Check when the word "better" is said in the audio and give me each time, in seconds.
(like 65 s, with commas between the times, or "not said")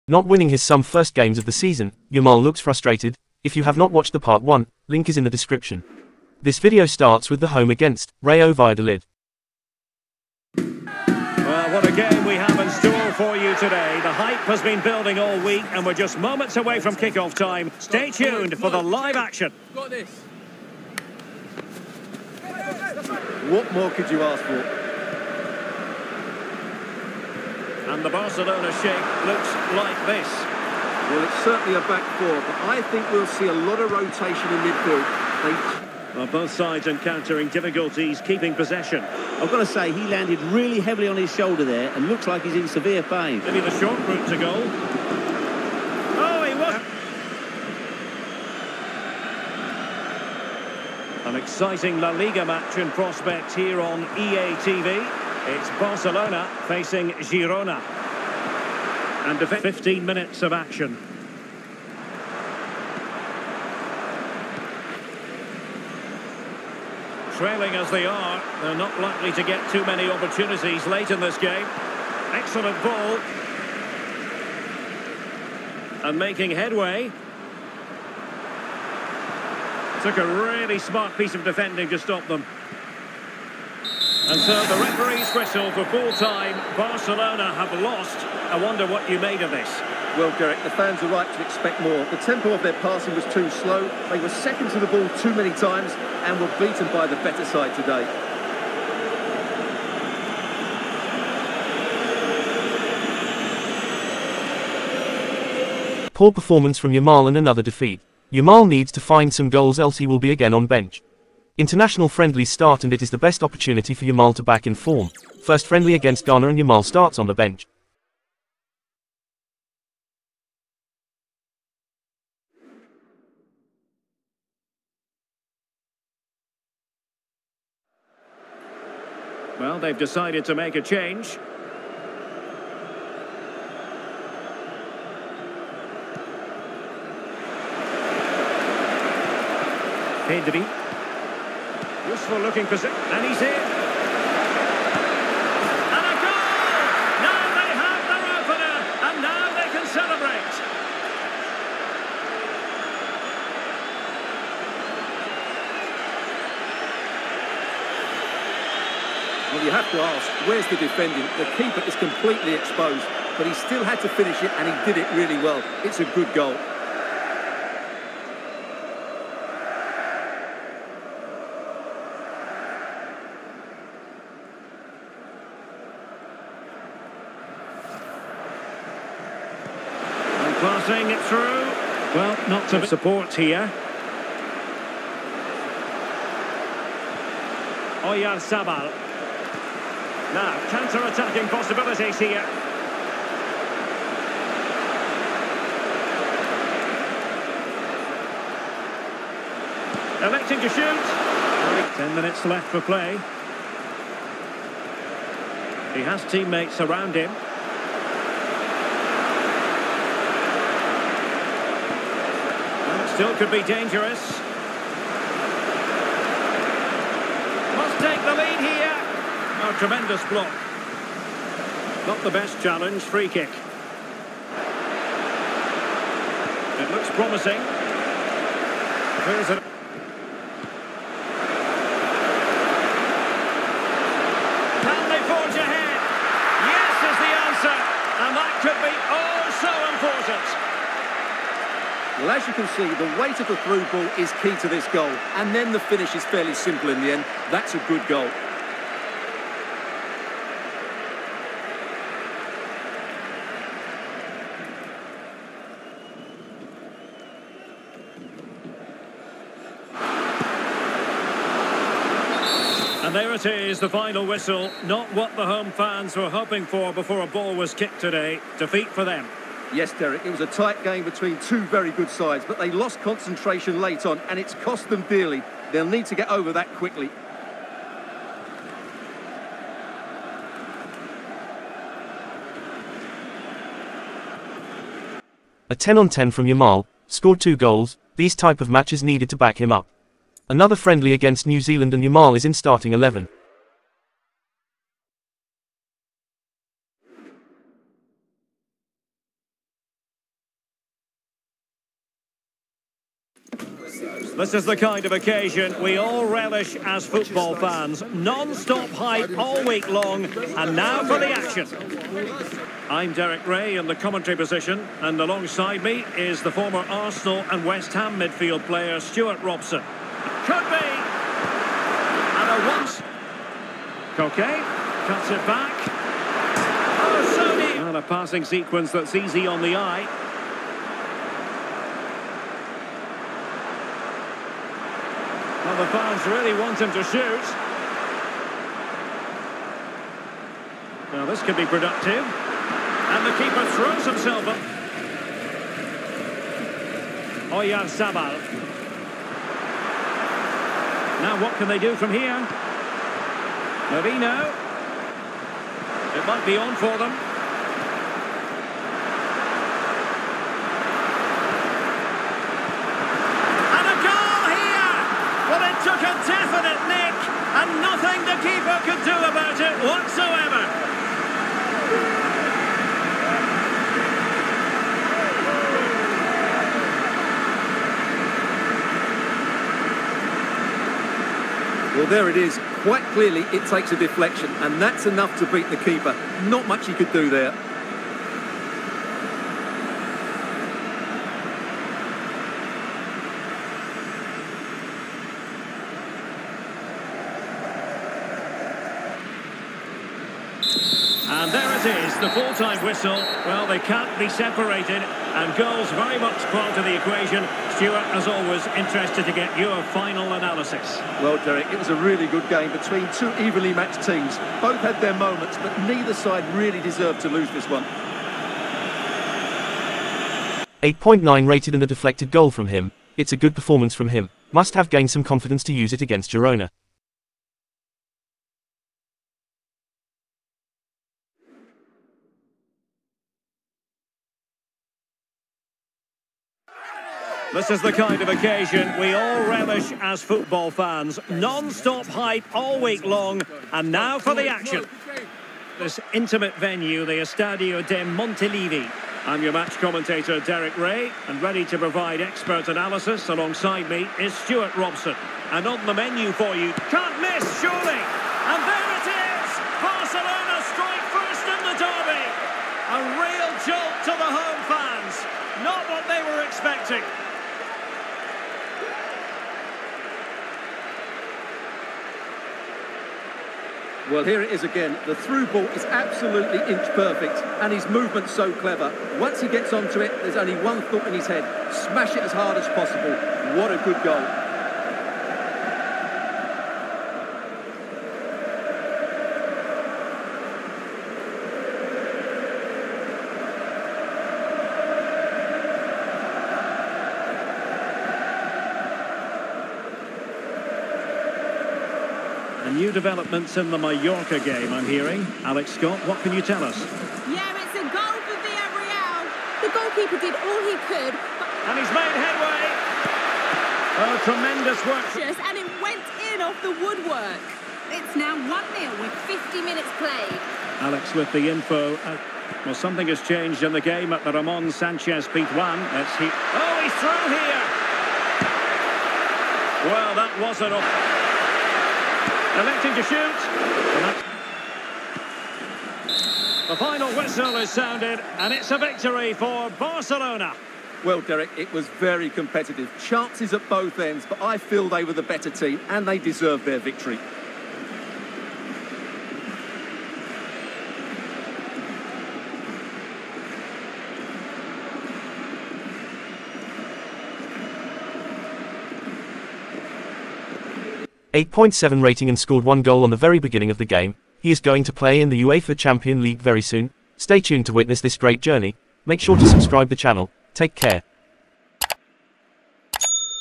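97 s, 545 s.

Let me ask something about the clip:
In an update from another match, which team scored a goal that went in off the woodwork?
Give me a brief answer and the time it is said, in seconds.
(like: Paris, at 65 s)
Villarreal, at 508 s.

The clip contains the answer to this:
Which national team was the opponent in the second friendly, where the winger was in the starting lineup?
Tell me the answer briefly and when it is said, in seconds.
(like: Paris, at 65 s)
New Zealand, at 291 s.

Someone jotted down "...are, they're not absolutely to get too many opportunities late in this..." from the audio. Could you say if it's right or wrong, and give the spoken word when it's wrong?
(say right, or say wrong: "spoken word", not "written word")
wrong: "likely", not "absolutely".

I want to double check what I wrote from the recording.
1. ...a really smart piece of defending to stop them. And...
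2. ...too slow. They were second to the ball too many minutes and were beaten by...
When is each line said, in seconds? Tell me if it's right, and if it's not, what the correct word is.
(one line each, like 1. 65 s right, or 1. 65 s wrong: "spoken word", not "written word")
1. 80 s right
2. 93 s wrong: "times", not "minutes".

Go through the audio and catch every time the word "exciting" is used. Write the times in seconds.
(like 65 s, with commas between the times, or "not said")
51 s.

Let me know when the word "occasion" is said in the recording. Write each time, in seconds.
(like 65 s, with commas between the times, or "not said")
305 s, 438 s.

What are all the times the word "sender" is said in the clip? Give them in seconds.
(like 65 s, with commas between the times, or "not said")
not said.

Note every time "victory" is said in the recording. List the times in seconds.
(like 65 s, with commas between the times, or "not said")
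538 s, 546 s.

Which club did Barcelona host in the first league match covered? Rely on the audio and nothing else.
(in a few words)
Rayo Valladolid.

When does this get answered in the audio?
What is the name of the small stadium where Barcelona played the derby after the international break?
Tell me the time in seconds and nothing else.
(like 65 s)
447 s.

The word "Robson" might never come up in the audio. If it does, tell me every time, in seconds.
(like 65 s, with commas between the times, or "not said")
319 s, 454 s.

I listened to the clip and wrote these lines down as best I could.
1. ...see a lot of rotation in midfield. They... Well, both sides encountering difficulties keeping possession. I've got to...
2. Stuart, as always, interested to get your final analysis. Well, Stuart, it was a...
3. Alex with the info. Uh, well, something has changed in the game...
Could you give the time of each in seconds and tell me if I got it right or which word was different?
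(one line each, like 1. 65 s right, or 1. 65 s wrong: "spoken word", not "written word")
1. 33 s right
2. 407 s wrong: "Derek", not "Stuart"
3. 520 s right.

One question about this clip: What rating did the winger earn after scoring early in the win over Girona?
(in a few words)
8.7.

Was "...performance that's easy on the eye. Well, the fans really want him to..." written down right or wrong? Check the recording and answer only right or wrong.
wrong.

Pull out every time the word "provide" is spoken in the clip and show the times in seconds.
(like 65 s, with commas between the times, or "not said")
451 s.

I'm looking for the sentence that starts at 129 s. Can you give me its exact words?
Well, they've decided to make a change.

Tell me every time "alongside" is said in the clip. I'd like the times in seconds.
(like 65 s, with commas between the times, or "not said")
315 s, 453 s.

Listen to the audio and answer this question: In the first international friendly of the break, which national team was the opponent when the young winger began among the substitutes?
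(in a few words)
Ghana.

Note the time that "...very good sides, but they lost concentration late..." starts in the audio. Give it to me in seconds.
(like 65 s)
271 s.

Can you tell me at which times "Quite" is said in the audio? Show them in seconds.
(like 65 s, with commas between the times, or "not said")
382 s.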